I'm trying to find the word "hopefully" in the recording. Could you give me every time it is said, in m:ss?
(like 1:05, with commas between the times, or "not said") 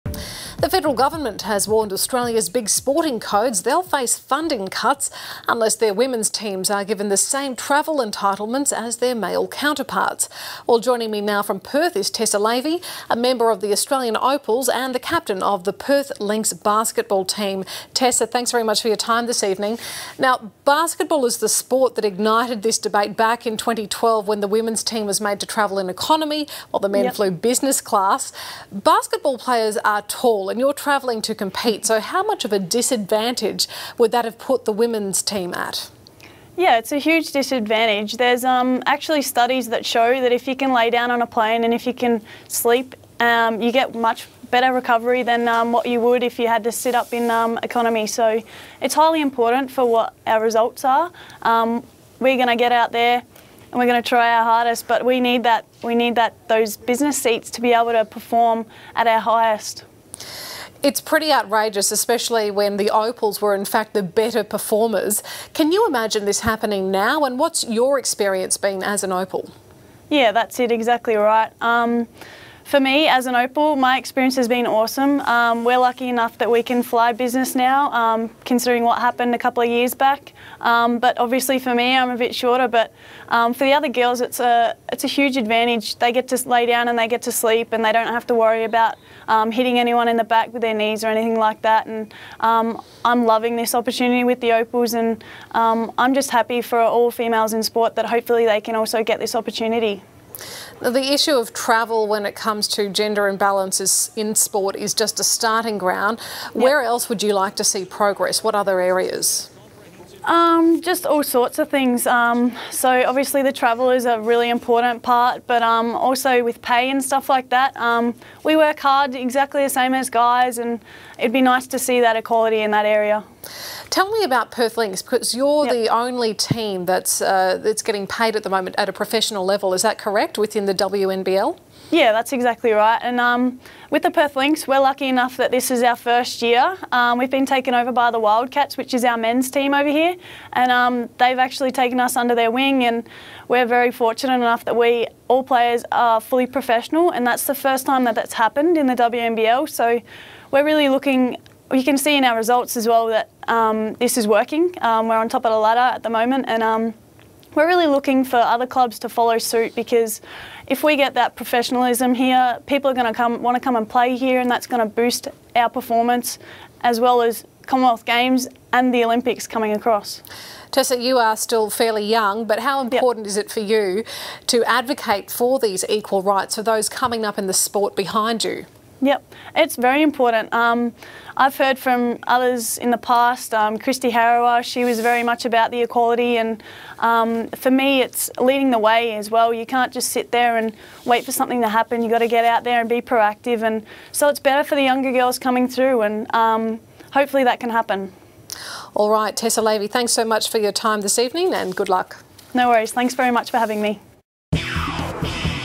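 1:38, 3:17.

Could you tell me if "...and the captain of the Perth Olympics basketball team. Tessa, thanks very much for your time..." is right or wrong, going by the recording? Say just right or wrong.
wrong.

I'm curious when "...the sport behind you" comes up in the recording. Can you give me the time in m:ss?
2:57.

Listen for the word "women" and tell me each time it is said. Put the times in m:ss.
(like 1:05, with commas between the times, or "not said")
0:05, 0:24, 0:34.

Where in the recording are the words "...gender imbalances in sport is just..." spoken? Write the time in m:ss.
1:42.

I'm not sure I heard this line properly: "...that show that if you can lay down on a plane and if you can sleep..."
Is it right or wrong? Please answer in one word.
right.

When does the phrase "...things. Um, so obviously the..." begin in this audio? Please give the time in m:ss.
1:51.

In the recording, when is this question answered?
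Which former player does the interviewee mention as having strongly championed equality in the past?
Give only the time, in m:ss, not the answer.
3:03.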